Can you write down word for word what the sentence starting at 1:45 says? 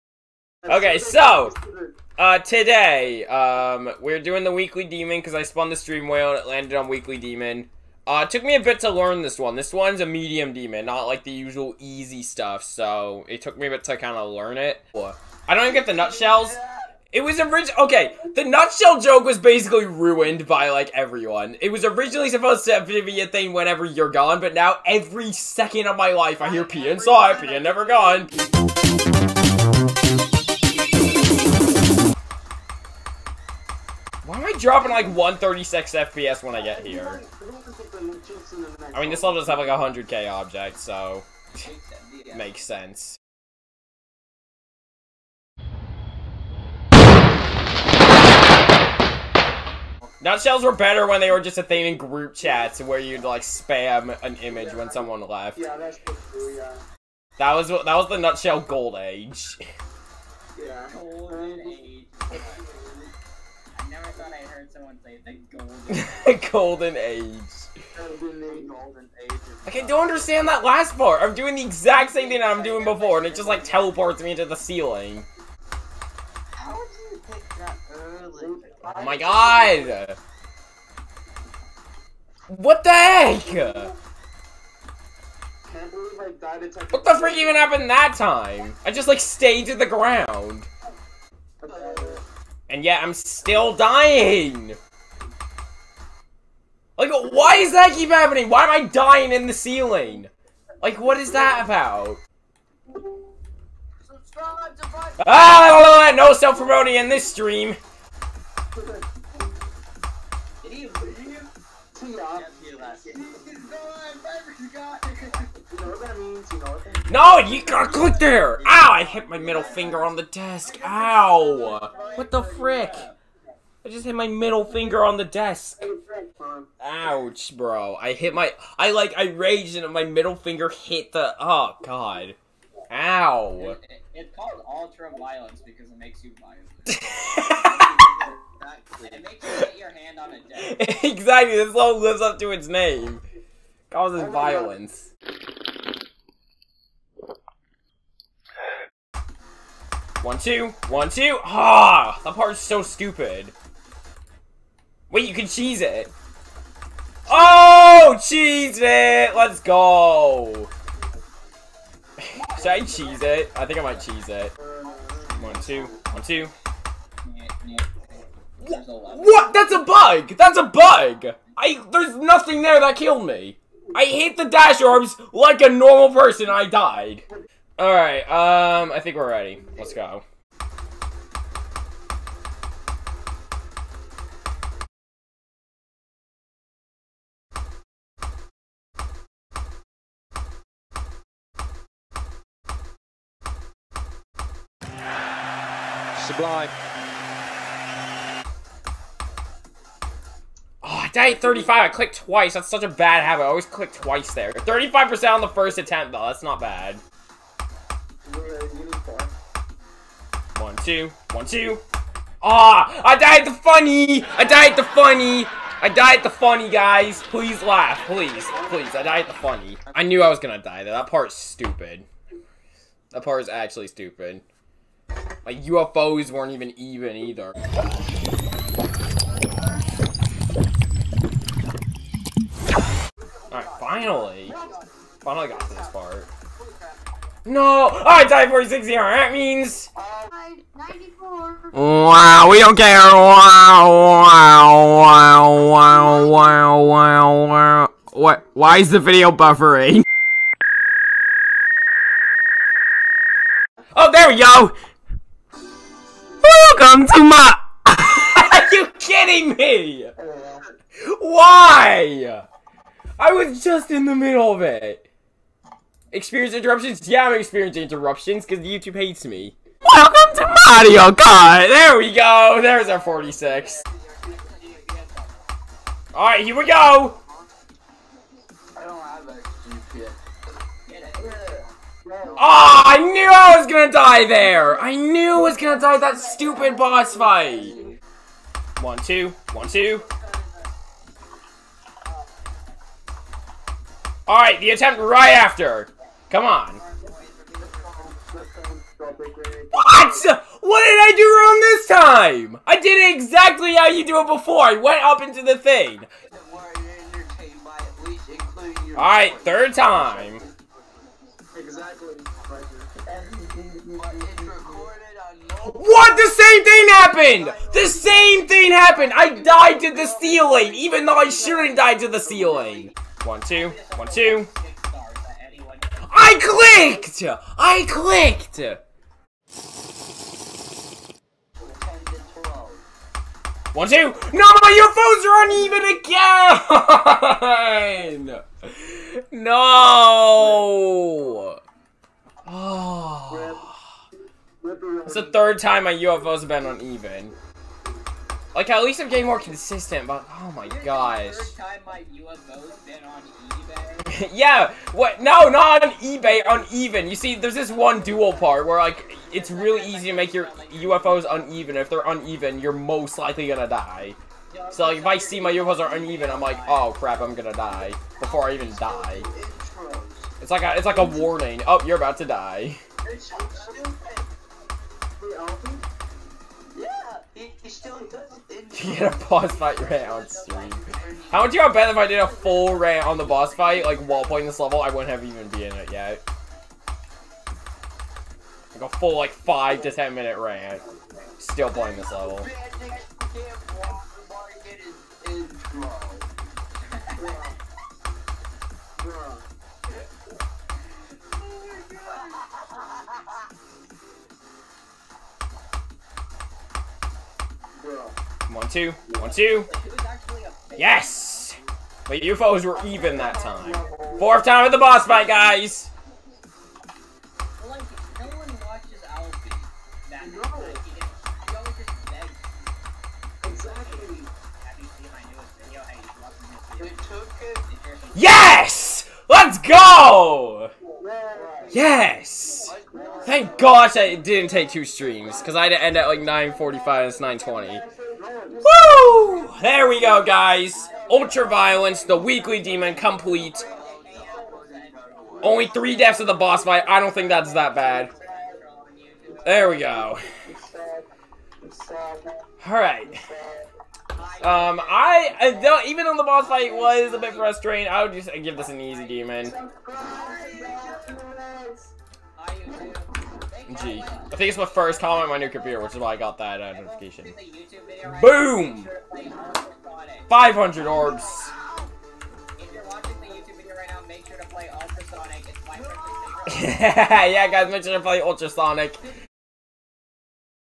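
Ah, no self-promoting in this stream!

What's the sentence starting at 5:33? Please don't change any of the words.
No, my UFOs are uneven again!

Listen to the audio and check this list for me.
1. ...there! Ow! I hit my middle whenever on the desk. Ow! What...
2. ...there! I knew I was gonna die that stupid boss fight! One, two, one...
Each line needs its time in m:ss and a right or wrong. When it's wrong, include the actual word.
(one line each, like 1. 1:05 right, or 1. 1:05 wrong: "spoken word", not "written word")
1. 1:58 wrong: "finger", not "whenever"
2. 4:44 right.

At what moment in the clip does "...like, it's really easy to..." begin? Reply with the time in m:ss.
5:58.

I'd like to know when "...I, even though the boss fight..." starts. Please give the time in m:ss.
7:34.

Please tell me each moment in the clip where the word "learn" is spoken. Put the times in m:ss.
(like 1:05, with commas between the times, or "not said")
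0:08, 0:14.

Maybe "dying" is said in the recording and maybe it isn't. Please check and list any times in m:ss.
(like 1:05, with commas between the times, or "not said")
1:33, 1:38.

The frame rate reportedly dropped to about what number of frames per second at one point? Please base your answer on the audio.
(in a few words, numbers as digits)
136.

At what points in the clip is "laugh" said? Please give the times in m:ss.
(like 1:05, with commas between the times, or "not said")
3:37.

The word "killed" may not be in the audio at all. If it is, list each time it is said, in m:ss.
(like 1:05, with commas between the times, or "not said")
2:52.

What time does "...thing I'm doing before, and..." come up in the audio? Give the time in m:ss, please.
1:12.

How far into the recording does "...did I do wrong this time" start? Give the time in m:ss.
5:00.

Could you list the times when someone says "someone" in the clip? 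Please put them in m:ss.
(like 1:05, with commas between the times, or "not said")
0:54, 1:04.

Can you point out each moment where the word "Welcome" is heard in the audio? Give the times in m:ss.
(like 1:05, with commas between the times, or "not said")
4:16, 4:29.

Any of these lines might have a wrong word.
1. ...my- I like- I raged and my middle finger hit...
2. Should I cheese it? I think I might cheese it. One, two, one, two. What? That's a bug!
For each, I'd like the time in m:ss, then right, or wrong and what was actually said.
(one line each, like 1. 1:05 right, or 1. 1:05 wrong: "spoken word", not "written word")
1. 2:08 right
2. 2:42 right.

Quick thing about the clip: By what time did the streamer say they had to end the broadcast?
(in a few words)
9:45.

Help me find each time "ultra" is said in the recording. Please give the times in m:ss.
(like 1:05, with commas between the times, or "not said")
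2:14, 7:21.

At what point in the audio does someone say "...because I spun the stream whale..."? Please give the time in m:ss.
0:05.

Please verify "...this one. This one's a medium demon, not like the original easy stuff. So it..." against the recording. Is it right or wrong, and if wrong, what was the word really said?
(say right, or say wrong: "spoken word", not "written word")
wrong: "usual", not "original".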